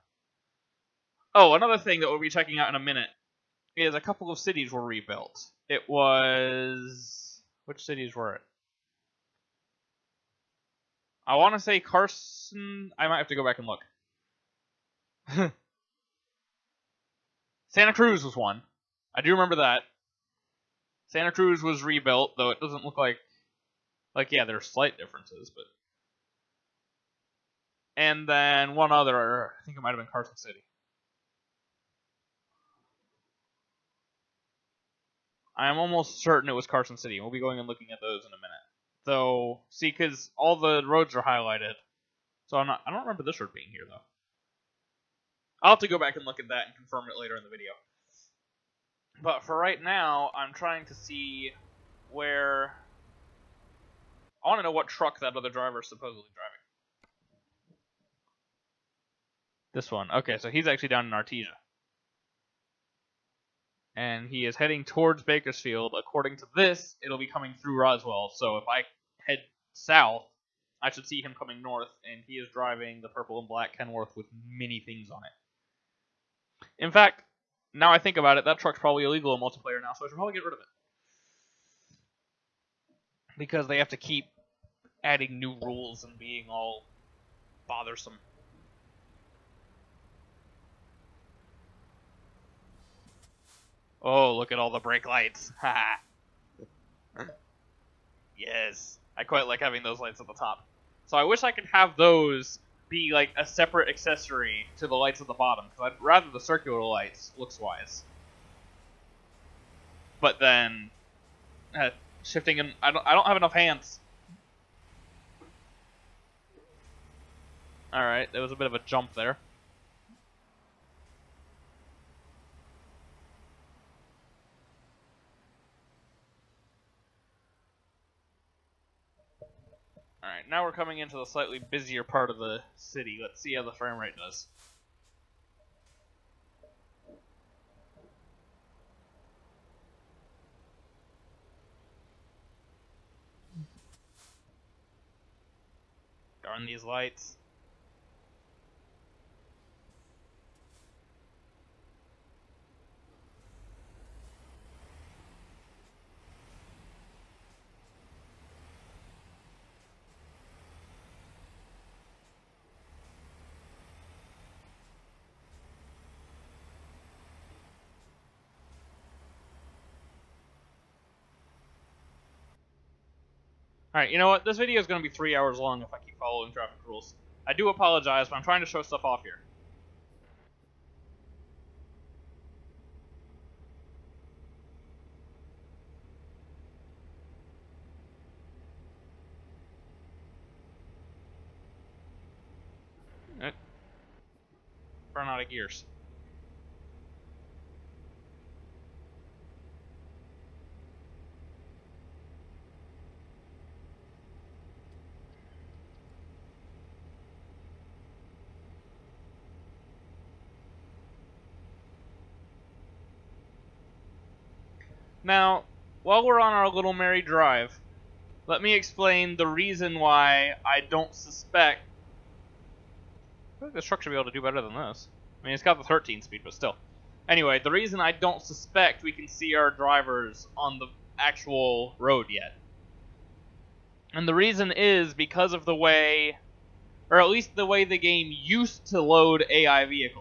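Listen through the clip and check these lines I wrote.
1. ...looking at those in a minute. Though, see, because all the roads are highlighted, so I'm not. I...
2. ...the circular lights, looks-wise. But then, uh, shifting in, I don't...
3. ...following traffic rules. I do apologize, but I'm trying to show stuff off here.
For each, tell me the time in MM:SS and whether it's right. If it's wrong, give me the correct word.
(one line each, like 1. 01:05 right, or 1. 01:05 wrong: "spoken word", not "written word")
1. 00:37 right
2. 01:46 right
3. 02:56 right.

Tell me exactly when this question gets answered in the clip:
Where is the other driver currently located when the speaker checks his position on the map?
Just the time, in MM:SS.
01:01.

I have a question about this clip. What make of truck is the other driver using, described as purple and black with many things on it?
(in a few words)
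Kenworth.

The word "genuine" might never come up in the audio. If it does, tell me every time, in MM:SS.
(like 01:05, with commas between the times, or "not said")
not said.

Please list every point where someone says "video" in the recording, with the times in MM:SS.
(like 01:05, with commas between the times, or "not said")
00:47, 02:54.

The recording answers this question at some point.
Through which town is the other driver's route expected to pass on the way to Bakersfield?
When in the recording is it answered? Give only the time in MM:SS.
01:07.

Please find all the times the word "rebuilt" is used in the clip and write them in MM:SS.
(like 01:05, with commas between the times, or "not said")
00:04, 00:21.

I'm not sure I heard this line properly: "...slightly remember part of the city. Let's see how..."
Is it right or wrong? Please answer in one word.
wrong.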